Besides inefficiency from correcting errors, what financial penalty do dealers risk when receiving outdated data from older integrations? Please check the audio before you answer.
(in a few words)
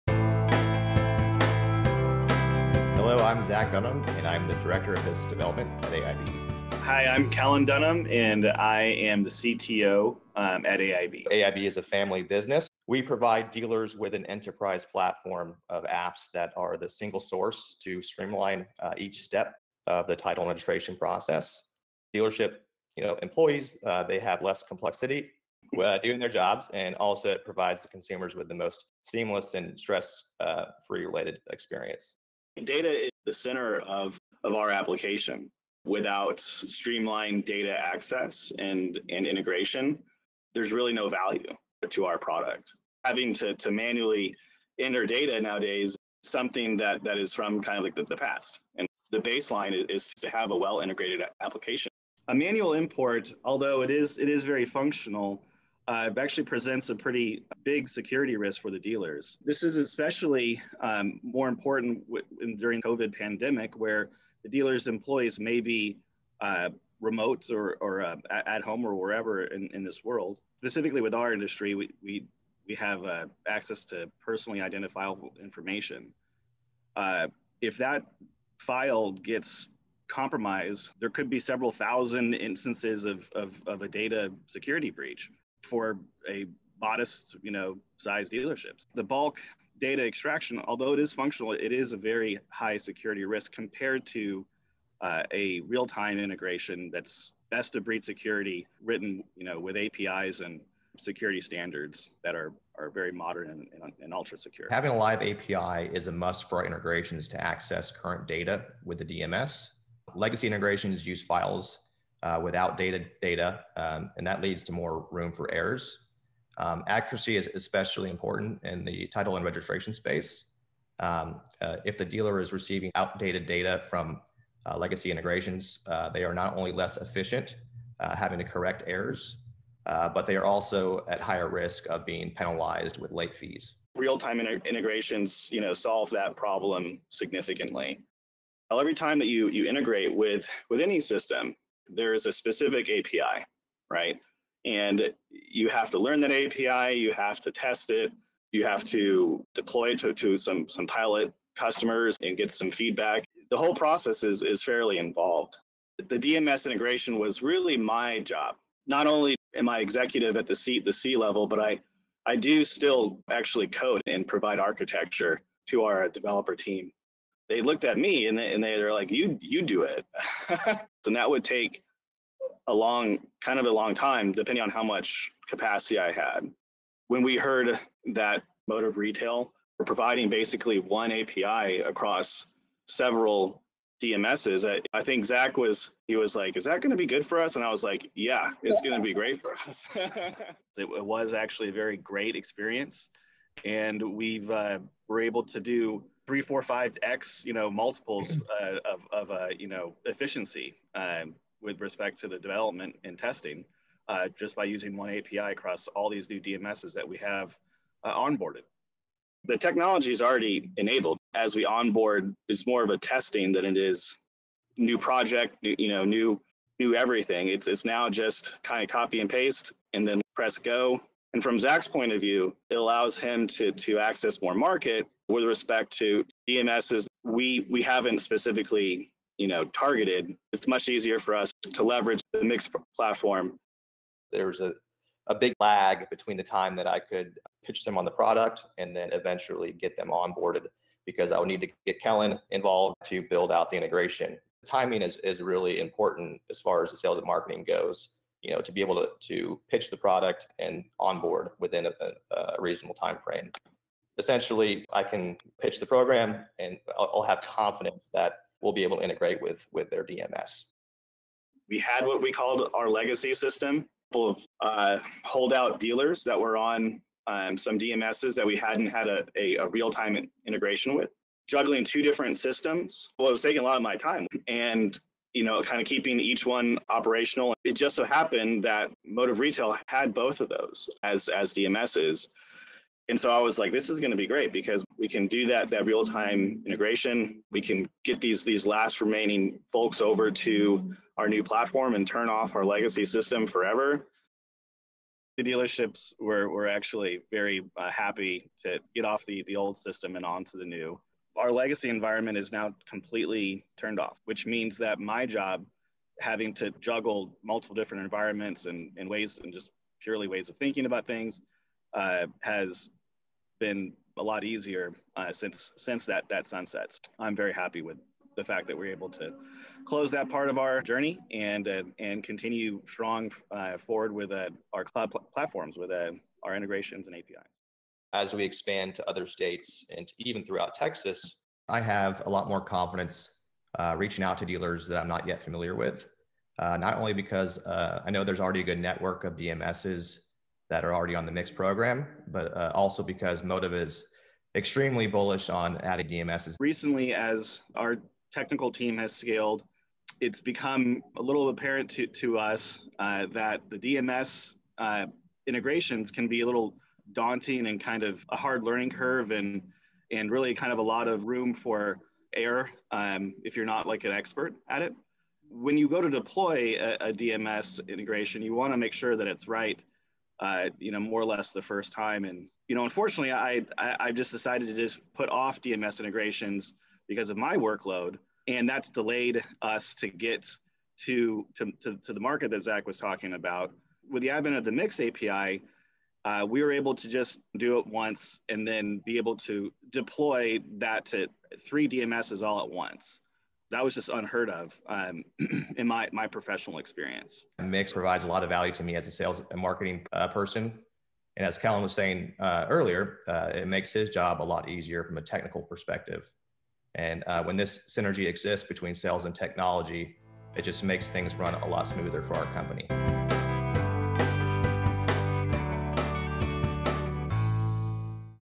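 late fees.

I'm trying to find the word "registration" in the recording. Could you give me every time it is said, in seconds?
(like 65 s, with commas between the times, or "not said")
20 s, 119 s.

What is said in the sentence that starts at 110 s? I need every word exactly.
Legacy integrations use files uh, without data, data um, and that leads to more room for errors.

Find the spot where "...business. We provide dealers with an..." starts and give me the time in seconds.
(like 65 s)
12 s.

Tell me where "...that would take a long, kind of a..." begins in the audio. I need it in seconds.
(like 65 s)
171 s.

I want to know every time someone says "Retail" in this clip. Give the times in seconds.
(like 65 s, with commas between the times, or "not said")
178 s, 279 s.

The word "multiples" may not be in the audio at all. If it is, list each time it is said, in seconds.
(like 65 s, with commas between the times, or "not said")
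197 s, 307 s.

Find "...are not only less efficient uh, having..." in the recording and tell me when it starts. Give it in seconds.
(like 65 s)
126 s.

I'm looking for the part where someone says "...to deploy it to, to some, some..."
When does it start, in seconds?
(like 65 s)
148 s.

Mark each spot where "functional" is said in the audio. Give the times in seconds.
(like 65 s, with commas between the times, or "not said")
54 s, 91 s.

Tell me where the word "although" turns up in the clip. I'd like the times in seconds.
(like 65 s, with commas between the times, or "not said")
53 s, 90 s.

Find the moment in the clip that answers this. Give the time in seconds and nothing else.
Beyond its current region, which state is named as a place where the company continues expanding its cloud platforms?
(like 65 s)
330 s.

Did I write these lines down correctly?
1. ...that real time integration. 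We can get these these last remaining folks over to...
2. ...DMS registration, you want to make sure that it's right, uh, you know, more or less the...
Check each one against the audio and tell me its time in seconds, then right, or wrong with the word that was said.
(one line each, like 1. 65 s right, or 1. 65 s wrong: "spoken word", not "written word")
1. 285 s right
2. 367 s wrong: "integration", not "registration".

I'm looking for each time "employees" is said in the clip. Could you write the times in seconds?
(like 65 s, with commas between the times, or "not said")
23 s, 64 s.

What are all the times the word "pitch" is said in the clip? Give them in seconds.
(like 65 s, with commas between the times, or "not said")
237 s, 249 s, 255 s.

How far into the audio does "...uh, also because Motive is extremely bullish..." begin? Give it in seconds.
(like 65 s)
342 s.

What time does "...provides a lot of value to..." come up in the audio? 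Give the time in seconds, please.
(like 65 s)
397 s.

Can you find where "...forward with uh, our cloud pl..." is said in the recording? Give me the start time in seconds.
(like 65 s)
323 s.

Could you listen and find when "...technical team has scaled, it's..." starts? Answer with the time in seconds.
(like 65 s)
348 s.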